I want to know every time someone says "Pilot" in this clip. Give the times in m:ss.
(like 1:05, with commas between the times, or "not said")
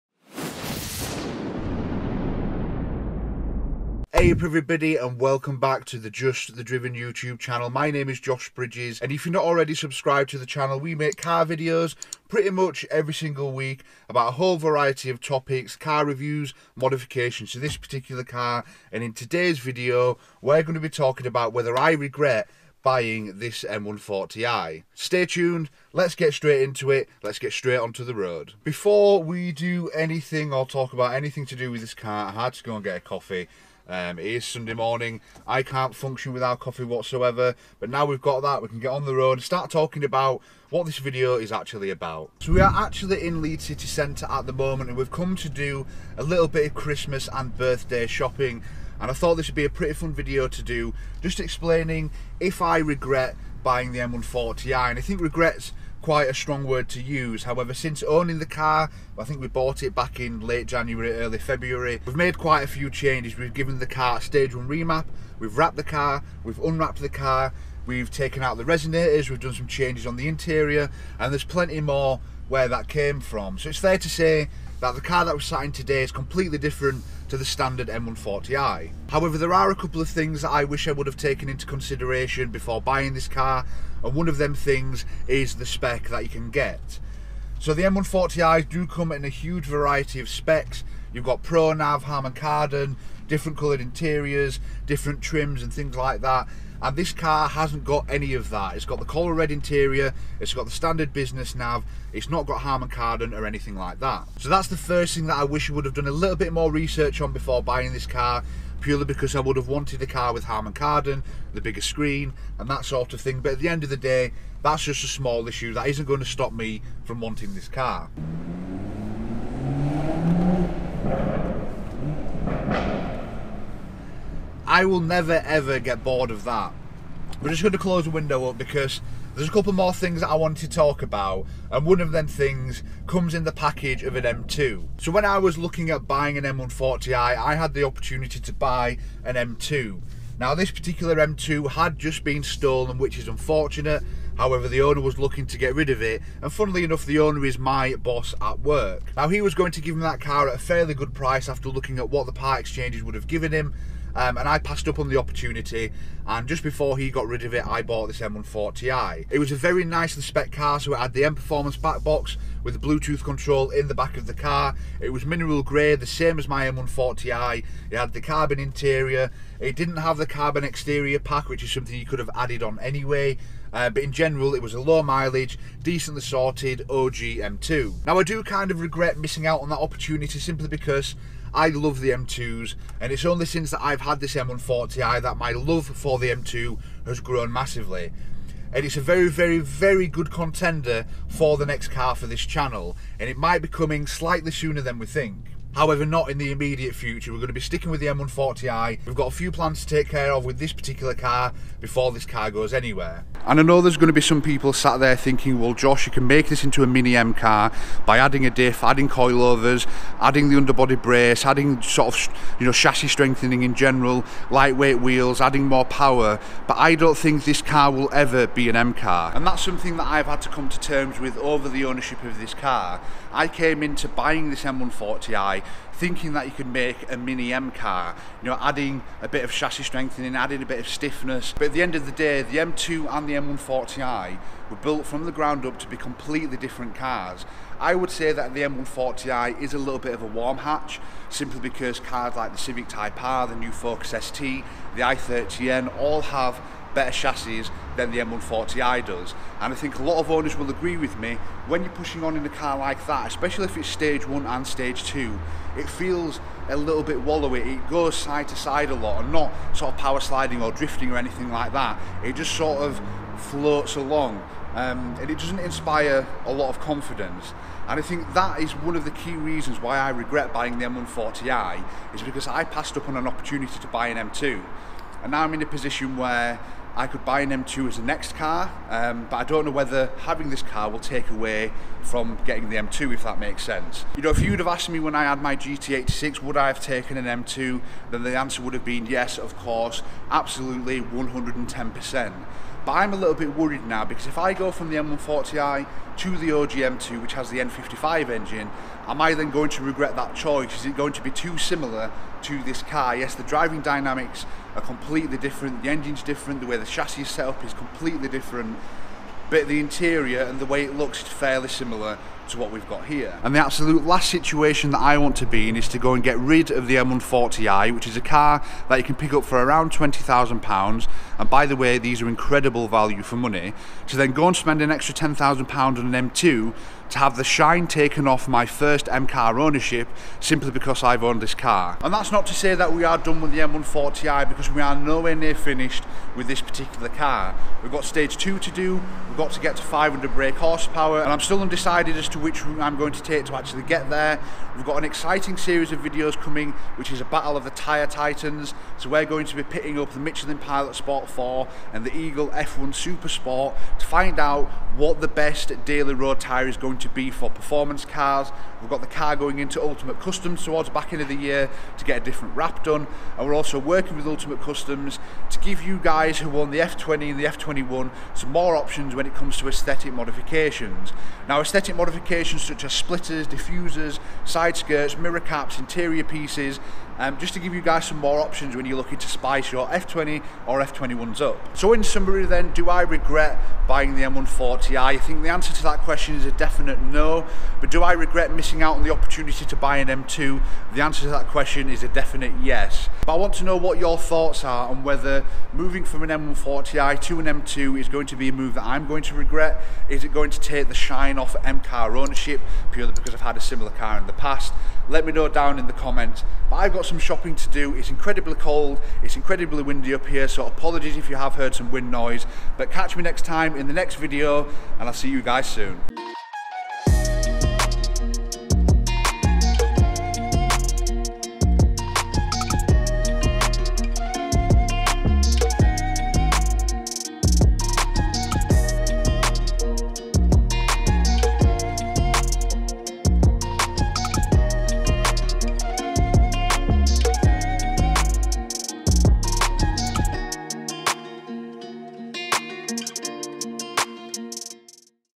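5:50.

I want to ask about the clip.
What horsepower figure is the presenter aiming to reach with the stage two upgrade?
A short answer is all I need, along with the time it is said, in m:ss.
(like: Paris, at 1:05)
500, at 5:39.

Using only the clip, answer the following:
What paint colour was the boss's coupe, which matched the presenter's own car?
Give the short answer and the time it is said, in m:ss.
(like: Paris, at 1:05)
Mineral grey, at 2:45.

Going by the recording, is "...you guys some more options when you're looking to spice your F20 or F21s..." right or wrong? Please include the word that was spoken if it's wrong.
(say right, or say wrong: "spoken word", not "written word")
right.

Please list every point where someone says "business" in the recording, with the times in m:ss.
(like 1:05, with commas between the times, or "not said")
1:41.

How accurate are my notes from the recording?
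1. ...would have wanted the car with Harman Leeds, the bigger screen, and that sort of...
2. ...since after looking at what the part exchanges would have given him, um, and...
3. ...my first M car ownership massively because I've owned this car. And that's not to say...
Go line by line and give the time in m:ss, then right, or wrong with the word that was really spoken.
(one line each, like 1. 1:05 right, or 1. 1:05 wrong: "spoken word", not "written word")
1. 1:49 wrong: "Kardon", not "Leeds"
2. 2:31 wrong: "price", not "since"
3. 5:28 wrong: "simply", not "massively".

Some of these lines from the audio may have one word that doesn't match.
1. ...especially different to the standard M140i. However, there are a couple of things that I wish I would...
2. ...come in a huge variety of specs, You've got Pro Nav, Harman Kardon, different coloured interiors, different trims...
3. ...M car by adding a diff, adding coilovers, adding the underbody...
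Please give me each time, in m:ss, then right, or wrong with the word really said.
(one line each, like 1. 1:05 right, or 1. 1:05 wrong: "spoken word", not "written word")
1. 1:16 wrong: "completely", not "especially"
2. 1:28 right
3. 3:27 right.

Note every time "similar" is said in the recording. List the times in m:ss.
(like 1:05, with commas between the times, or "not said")
5:01, 5:11, 6:43.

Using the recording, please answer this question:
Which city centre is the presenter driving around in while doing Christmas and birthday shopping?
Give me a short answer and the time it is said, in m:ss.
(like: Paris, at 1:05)
Leeds, at 0:43.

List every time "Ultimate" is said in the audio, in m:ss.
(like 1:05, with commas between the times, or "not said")
5:59, 6:04.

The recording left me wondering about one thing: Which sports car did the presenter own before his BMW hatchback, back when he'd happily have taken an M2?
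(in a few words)
GT86.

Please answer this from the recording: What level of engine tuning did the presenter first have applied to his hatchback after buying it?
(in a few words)
Stage one remap.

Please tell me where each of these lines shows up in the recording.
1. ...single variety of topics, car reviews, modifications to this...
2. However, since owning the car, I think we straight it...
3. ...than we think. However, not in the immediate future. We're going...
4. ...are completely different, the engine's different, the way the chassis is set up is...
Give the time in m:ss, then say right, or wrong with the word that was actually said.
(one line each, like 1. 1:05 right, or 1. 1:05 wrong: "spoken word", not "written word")
1. 0:14 wrong: "whole", not "single"
2. 0:57 wrong: "bought", not "straight"
3. 3:14 right
4. 5:04 right.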